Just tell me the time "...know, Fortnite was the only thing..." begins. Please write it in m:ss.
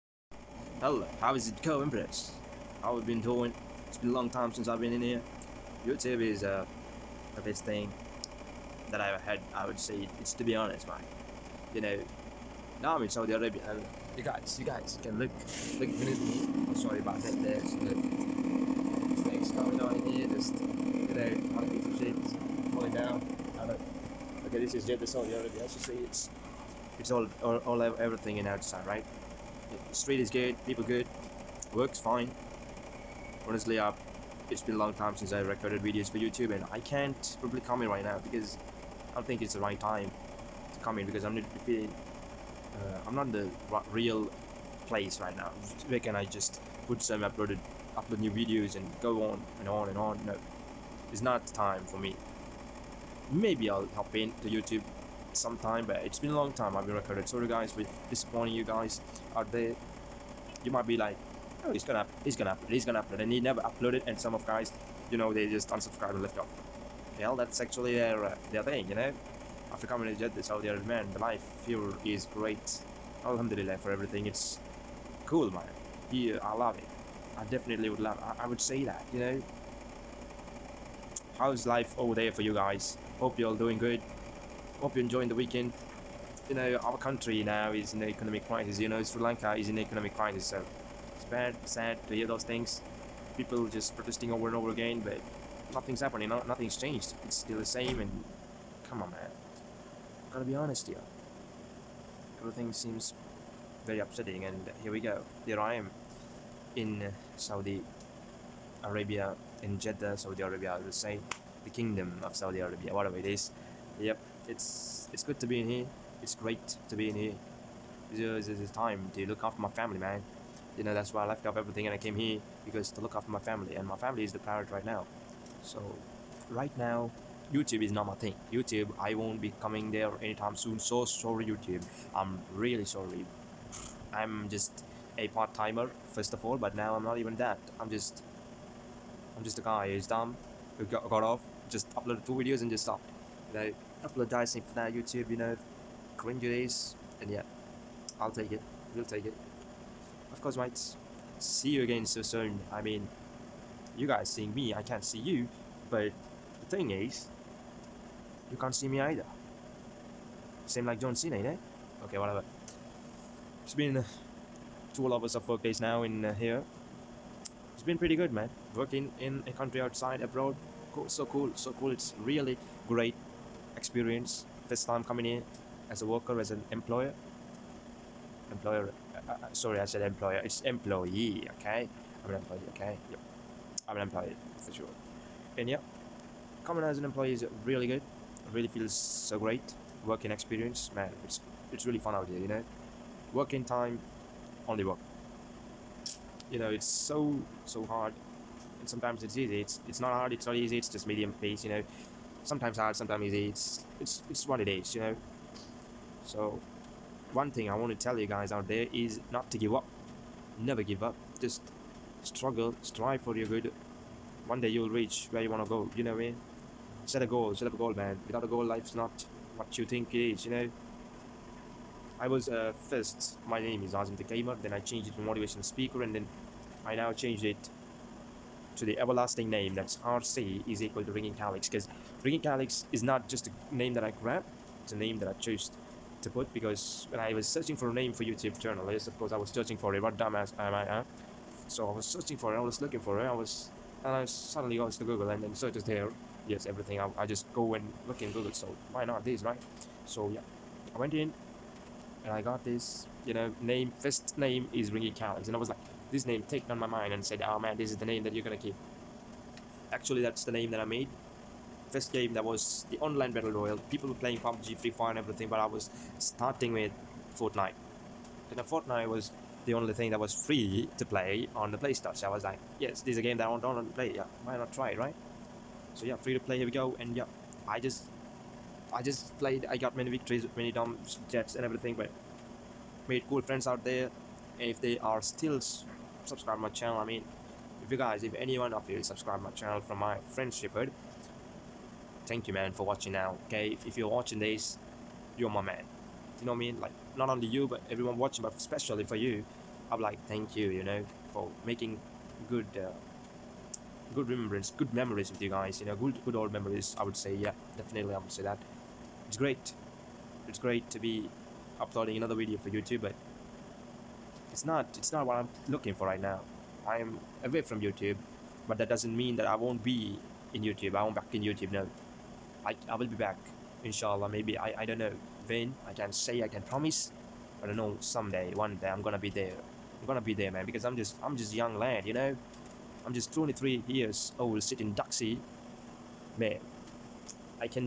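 4:28.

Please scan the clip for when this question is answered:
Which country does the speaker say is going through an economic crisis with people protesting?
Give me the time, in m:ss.
1:29.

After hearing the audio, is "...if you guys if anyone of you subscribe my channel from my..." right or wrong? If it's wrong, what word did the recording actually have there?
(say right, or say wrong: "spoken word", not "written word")
right.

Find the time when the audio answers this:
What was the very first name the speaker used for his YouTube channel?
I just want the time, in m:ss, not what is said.
3:43.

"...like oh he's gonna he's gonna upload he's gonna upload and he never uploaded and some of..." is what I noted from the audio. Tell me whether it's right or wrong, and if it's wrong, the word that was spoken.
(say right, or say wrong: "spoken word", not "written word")
right.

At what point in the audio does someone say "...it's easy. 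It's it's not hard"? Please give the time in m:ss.
3:19.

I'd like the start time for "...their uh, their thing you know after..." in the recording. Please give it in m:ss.
1:07.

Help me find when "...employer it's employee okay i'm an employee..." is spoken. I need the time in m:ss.
3:00.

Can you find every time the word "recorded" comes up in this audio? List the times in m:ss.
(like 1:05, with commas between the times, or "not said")
0:35, 0:56.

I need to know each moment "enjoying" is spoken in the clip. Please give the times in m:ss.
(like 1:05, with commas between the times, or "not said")
1:25.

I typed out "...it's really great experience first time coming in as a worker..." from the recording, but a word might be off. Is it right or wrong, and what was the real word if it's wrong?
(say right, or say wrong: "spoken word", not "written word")
right.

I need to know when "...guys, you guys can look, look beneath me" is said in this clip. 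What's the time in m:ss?
0:14.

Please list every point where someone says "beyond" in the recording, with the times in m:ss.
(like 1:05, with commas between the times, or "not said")
not said.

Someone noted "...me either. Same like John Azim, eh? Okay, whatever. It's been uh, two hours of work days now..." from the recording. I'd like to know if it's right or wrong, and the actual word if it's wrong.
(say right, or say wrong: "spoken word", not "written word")
wrong: "Cena", not "Azim".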